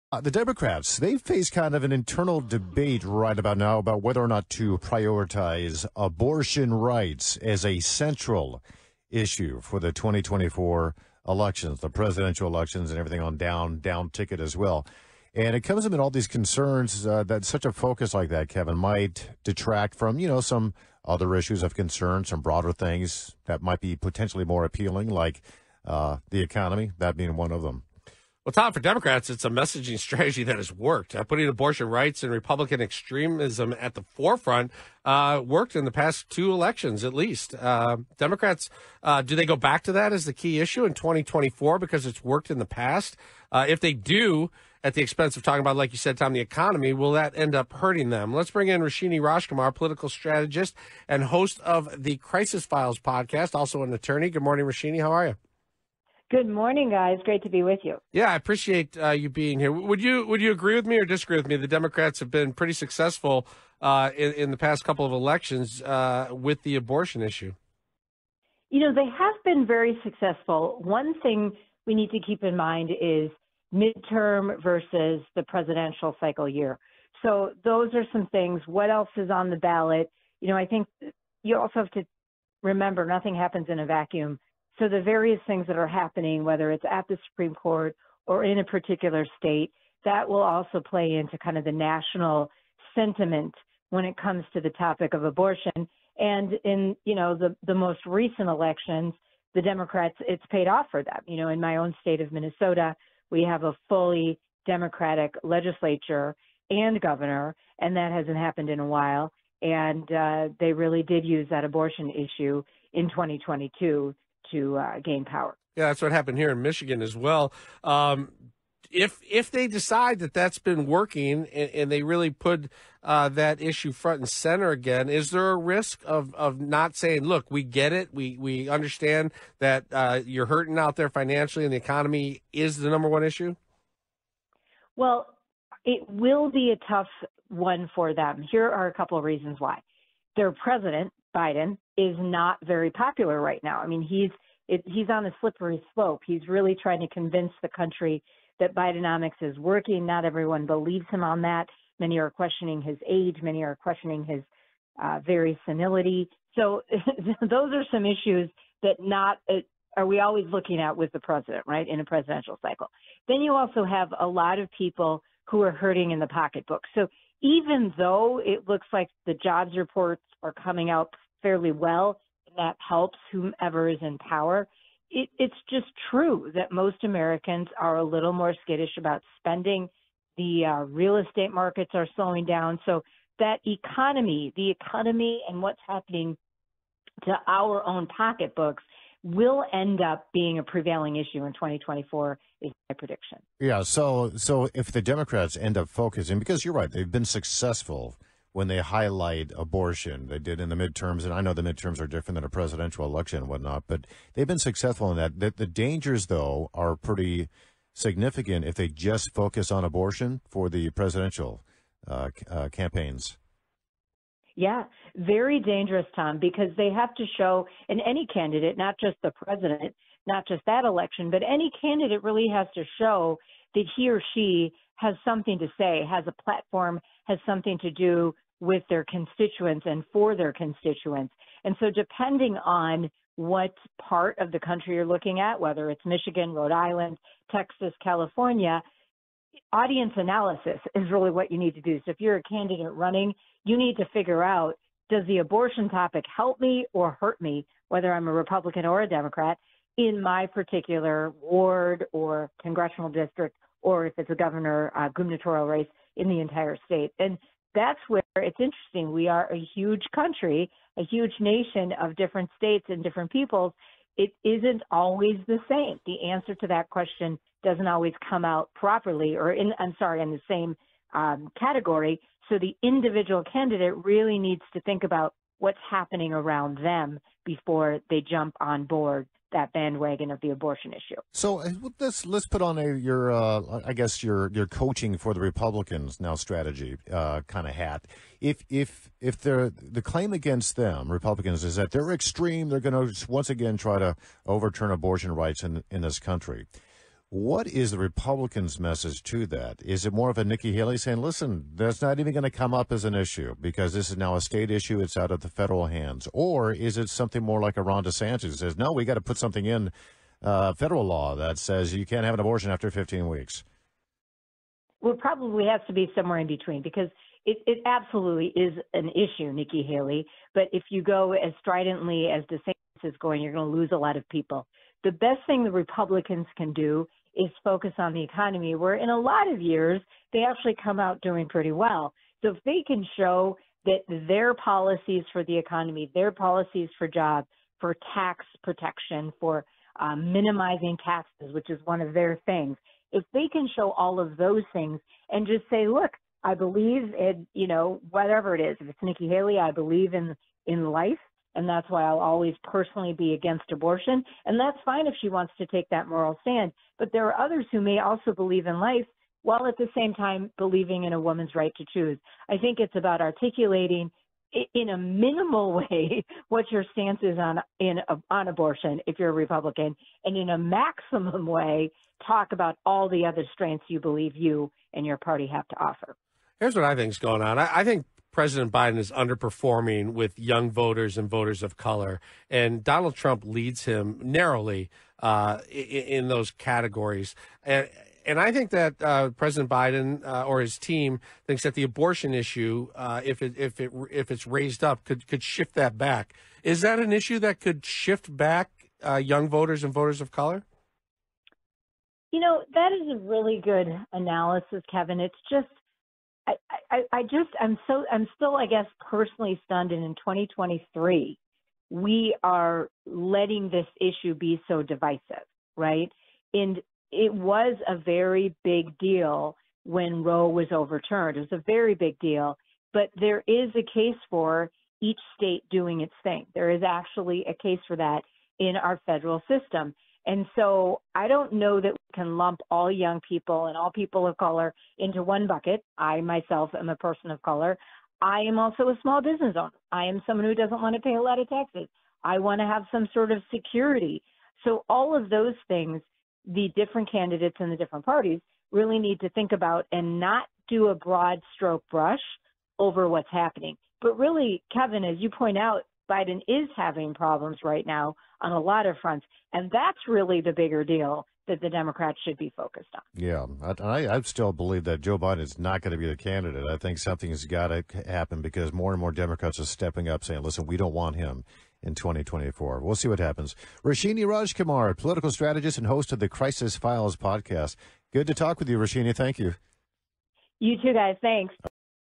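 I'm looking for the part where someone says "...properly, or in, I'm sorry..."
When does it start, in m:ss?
4:28.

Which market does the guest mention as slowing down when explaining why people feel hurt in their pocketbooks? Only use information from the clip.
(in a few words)
real estate.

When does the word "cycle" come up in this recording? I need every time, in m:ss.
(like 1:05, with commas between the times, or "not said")
1:16, 2:42.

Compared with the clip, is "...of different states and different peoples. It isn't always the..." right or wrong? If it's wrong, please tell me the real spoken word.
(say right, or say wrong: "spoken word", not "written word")
right.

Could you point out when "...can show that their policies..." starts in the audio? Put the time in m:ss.
5:32.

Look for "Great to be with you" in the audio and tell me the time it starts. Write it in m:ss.
0:57.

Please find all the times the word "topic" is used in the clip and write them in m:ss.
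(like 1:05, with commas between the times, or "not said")
1:34, 4:05.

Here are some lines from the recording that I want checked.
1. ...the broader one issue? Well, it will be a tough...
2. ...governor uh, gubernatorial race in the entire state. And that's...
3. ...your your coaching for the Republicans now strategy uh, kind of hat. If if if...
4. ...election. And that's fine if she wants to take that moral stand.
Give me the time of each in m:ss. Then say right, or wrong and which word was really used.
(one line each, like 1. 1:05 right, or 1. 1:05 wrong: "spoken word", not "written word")
1. 2:12 wrong: "number", not "broader"
2. 4:14 right
3. 4:44 right
4. 5:53 wrong: "abortion", not "election".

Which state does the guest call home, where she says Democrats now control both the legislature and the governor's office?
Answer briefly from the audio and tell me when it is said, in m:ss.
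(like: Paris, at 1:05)
Minnesota, at 1:42.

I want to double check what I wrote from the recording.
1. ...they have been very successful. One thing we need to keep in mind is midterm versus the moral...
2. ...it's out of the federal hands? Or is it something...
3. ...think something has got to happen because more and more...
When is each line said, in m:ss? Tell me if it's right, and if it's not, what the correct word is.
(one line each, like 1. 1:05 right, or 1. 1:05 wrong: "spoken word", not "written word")
1. 1:08 wrong: "presidential", not "moral"
2. 5:04 right
3. 7:46 right.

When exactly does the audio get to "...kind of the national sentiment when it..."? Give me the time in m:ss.
1:31.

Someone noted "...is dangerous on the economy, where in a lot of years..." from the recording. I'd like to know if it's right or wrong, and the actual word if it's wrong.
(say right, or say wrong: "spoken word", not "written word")
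wrong: "focus", not "dangerous".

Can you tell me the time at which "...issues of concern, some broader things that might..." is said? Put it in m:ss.
0:21.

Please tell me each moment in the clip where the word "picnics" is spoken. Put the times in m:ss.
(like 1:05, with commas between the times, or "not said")
not said.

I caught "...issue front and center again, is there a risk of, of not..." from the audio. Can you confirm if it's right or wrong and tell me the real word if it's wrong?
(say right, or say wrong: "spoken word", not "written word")
right.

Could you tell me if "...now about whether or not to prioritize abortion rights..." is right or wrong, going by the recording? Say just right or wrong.
right.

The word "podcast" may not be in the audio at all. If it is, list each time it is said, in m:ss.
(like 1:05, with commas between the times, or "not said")
0:52, 7:57.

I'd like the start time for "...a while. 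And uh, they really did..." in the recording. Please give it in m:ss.
1:48.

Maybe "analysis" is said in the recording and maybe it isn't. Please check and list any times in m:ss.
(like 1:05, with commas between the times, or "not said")
4:00, 6:44.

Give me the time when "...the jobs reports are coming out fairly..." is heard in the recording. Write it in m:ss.
2:49.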